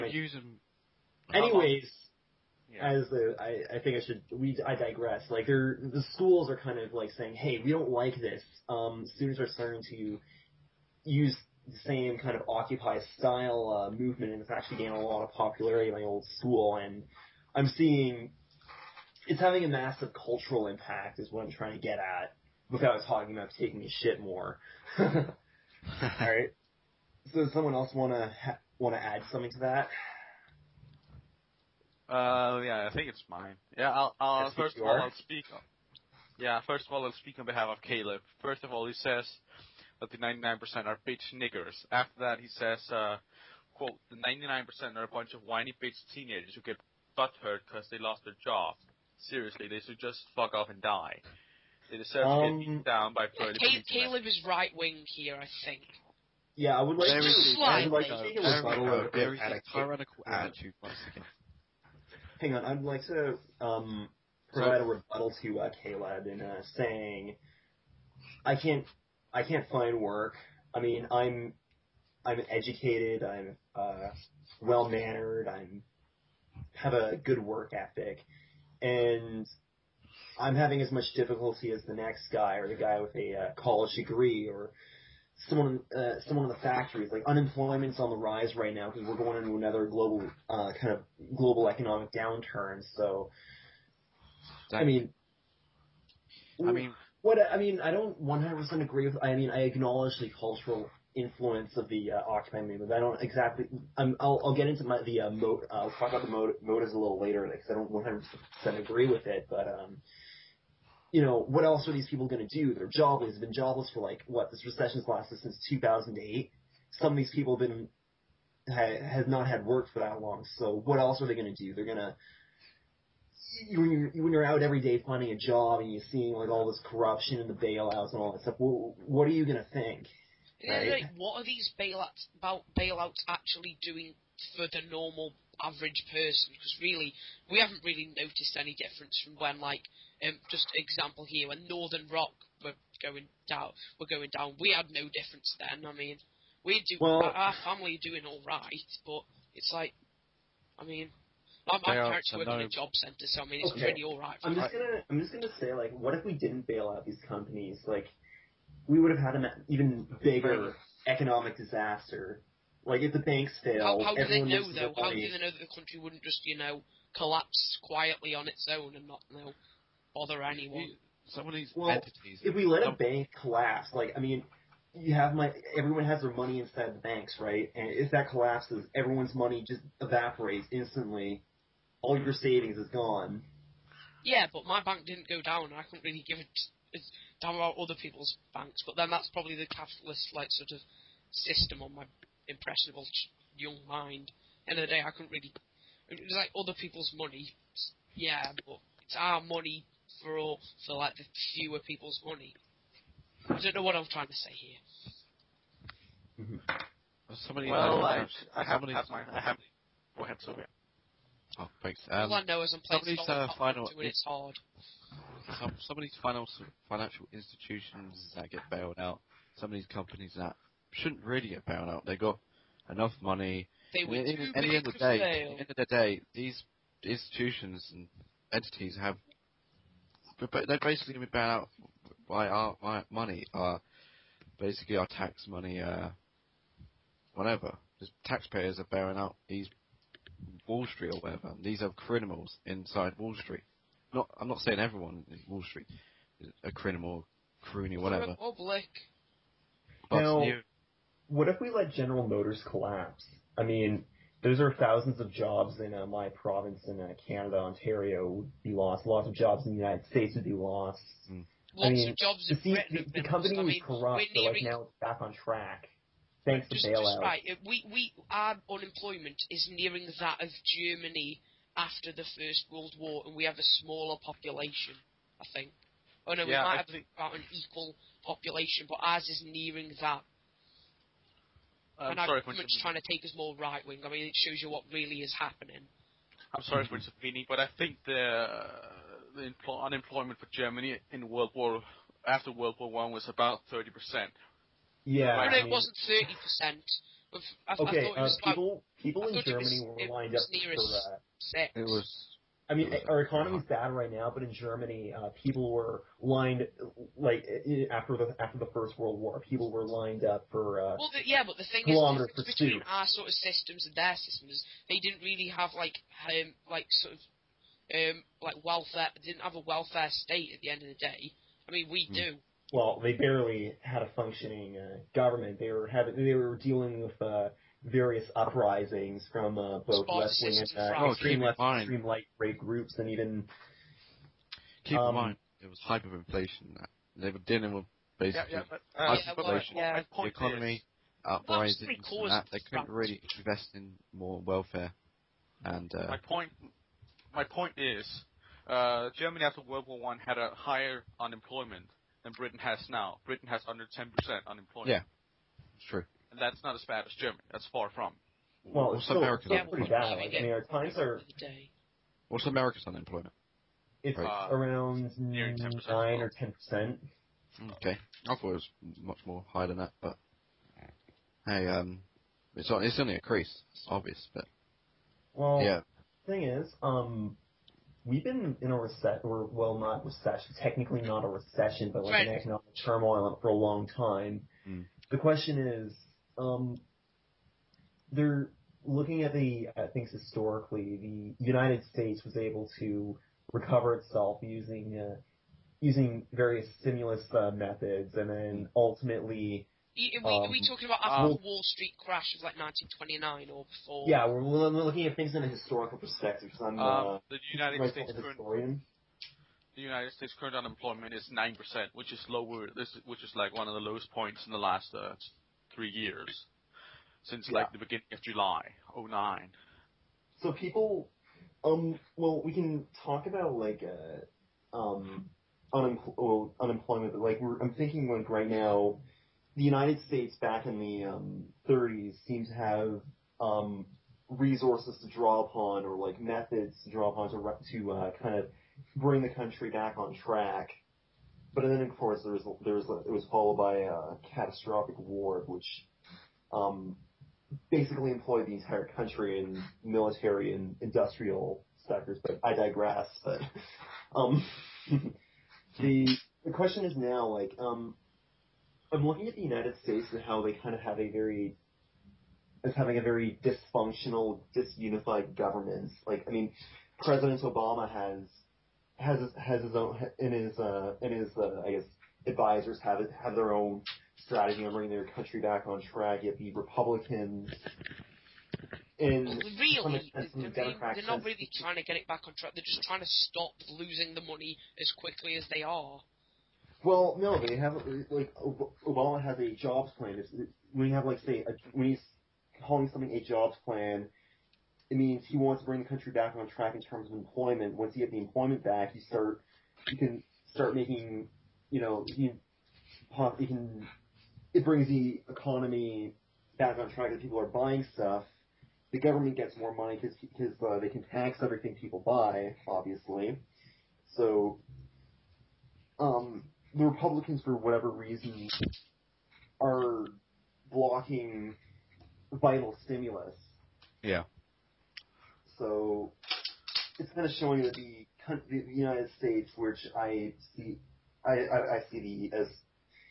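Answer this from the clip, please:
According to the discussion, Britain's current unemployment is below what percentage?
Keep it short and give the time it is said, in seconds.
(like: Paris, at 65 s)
10%, at 353 s.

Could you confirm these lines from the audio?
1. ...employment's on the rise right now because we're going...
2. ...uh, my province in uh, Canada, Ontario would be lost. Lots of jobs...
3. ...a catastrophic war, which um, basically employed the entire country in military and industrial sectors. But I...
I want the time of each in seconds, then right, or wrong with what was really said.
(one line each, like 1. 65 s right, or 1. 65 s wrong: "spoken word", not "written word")
1. 87 s wrong: "unemployment", not "employment"
2. 255 s right
3. 443 s right.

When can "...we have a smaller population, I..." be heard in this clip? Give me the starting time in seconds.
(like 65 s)
273 s.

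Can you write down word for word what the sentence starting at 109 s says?
um you know, what else are these people going to do?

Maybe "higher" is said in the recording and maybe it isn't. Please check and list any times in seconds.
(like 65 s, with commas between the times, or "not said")
350 s, 369 s.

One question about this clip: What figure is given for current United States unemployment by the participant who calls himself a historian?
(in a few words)
9%.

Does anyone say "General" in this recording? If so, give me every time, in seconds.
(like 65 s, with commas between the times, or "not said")
251 s.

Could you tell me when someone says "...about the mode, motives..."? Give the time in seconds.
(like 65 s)
106 s.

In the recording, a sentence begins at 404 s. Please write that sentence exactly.
Yeah, we're, looking at things in a historical perspective because I'm uh, uh, the United States historian.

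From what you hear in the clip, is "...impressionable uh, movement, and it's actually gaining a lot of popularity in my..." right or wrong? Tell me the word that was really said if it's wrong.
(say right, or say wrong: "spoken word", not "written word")
wrong: "style", not "impressionable".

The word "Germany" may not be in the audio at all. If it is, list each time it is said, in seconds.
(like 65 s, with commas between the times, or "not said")
270 s, 290 s, 299 s, 304 s, 349 s, 357 s.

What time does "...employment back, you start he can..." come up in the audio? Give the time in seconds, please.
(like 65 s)
498 s.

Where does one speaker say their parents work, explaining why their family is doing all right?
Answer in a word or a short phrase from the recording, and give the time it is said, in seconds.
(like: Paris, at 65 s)
A job centre, at 152 s.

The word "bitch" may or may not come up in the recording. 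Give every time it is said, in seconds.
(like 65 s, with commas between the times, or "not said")
41 s, 45 s.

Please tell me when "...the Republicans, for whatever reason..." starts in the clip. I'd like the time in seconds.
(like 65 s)
516 s.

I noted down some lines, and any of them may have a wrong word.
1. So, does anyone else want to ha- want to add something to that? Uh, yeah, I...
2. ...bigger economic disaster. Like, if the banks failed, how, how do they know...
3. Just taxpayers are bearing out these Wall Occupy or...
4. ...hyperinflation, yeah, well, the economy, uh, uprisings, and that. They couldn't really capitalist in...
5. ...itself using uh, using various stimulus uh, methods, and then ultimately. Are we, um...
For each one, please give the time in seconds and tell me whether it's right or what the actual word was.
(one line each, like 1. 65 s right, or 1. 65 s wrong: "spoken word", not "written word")
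1. 27 s wrong: "someone", not "anyone"
2. 160 s right
3. 237 s wrong: "Street", not "Occupy"
4. 339 s wrong: "invest", not "capitalist"
5. 393 s right.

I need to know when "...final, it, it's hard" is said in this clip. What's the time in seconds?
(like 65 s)
213 s.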